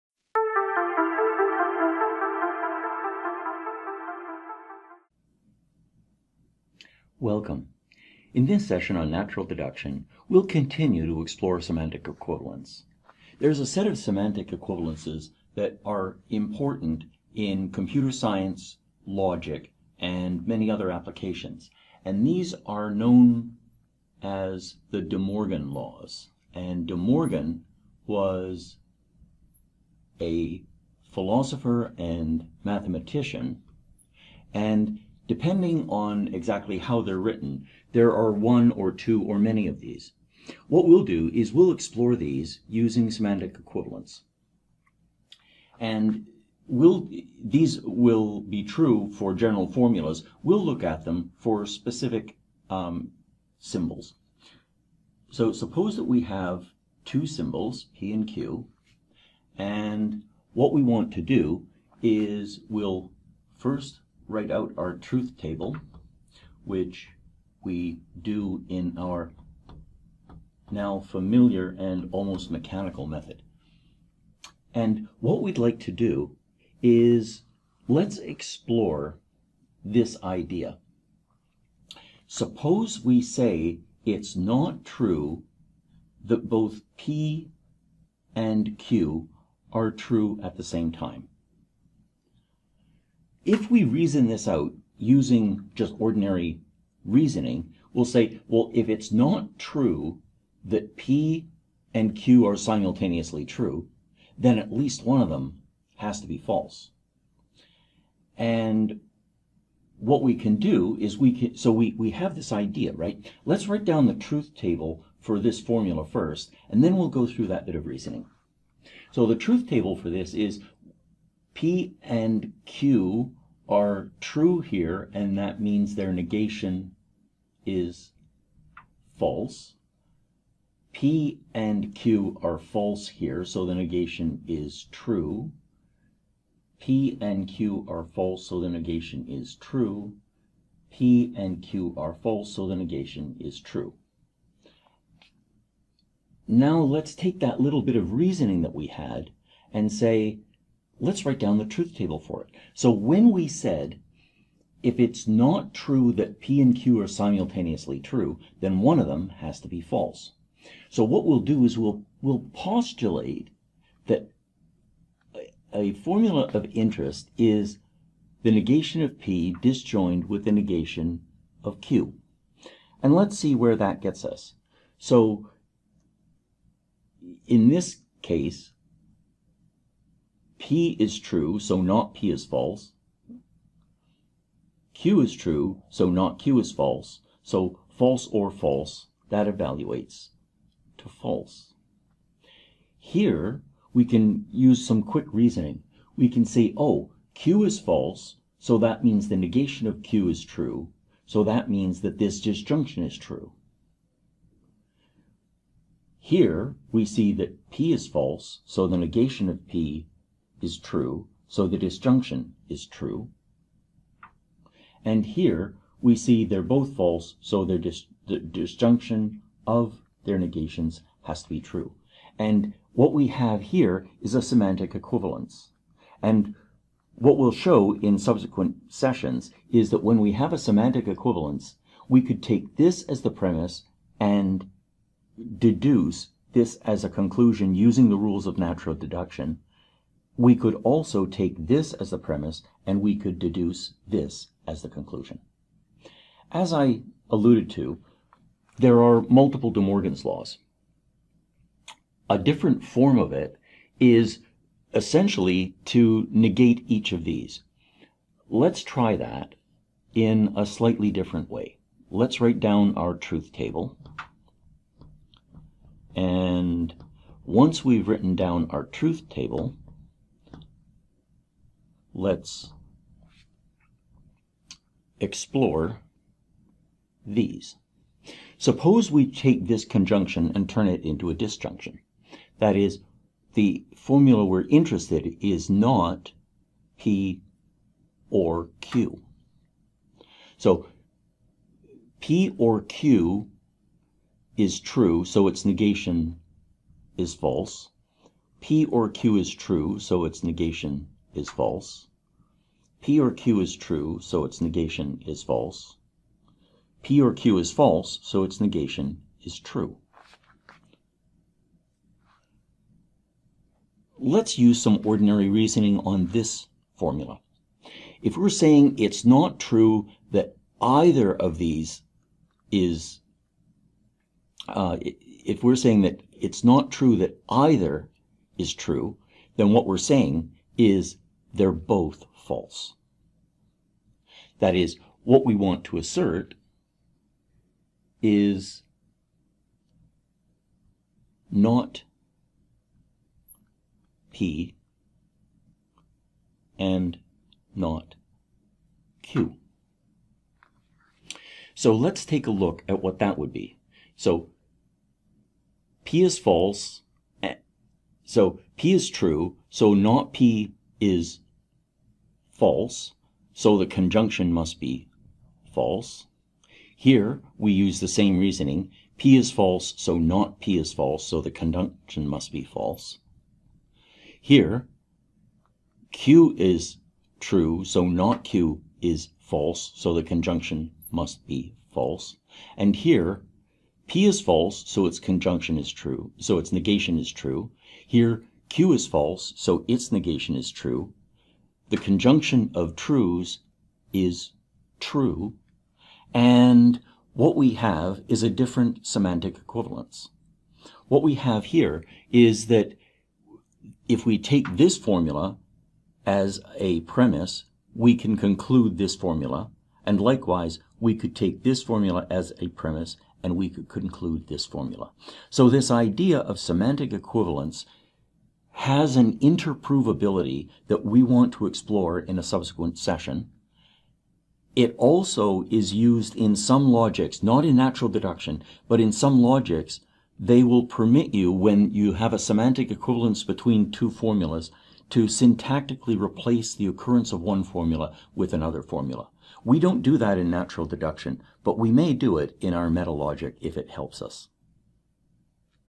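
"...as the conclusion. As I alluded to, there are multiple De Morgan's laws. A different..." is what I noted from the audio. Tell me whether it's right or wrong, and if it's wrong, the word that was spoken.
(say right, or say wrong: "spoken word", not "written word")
right.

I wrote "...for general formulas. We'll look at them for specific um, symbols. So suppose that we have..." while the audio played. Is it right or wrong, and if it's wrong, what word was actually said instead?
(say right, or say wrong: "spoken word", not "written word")
right.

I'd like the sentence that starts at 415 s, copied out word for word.
So this idea of semantic equivalence has an interprovability that we want to explore in a subsequent session.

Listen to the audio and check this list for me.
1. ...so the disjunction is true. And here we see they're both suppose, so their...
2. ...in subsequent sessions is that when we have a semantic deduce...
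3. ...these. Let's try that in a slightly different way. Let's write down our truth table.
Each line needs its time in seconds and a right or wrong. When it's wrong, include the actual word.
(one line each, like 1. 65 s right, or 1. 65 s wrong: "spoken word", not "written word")
1. 211 s wrong: "false", not "suppose"
2. 227 s wrong: "equivalence", not "deduce"
3. 257 s right.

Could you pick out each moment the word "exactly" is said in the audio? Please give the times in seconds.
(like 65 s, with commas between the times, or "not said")
36 s.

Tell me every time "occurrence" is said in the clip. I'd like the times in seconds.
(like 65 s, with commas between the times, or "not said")
436 s.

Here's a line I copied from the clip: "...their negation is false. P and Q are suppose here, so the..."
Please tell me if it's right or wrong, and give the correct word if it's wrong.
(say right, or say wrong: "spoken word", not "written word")
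wrong: "false", not "suppose".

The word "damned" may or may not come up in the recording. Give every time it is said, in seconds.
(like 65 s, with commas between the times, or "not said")
not said.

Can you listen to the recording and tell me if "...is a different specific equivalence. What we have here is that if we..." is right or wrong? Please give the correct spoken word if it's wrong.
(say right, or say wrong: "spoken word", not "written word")
wrong: "semantic", not "specific".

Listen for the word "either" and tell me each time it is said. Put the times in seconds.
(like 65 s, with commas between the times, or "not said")
320 s, 327 s.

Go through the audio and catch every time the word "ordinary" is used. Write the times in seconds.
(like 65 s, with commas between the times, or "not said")
95 s, 315 s.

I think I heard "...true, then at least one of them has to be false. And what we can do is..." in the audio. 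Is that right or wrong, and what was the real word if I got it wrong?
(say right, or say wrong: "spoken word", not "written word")
right.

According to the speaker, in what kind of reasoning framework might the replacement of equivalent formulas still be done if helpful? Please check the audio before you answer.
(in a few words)
Metalogic.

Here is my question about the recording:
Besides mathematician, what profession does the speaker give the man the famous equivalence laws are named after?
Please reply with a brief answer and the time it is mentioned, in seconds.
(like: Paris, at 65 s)
Philosopher, at 31 s.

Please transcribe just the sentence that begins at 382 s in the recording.
And here, P is false, so its conjunction is true, so its negation is true.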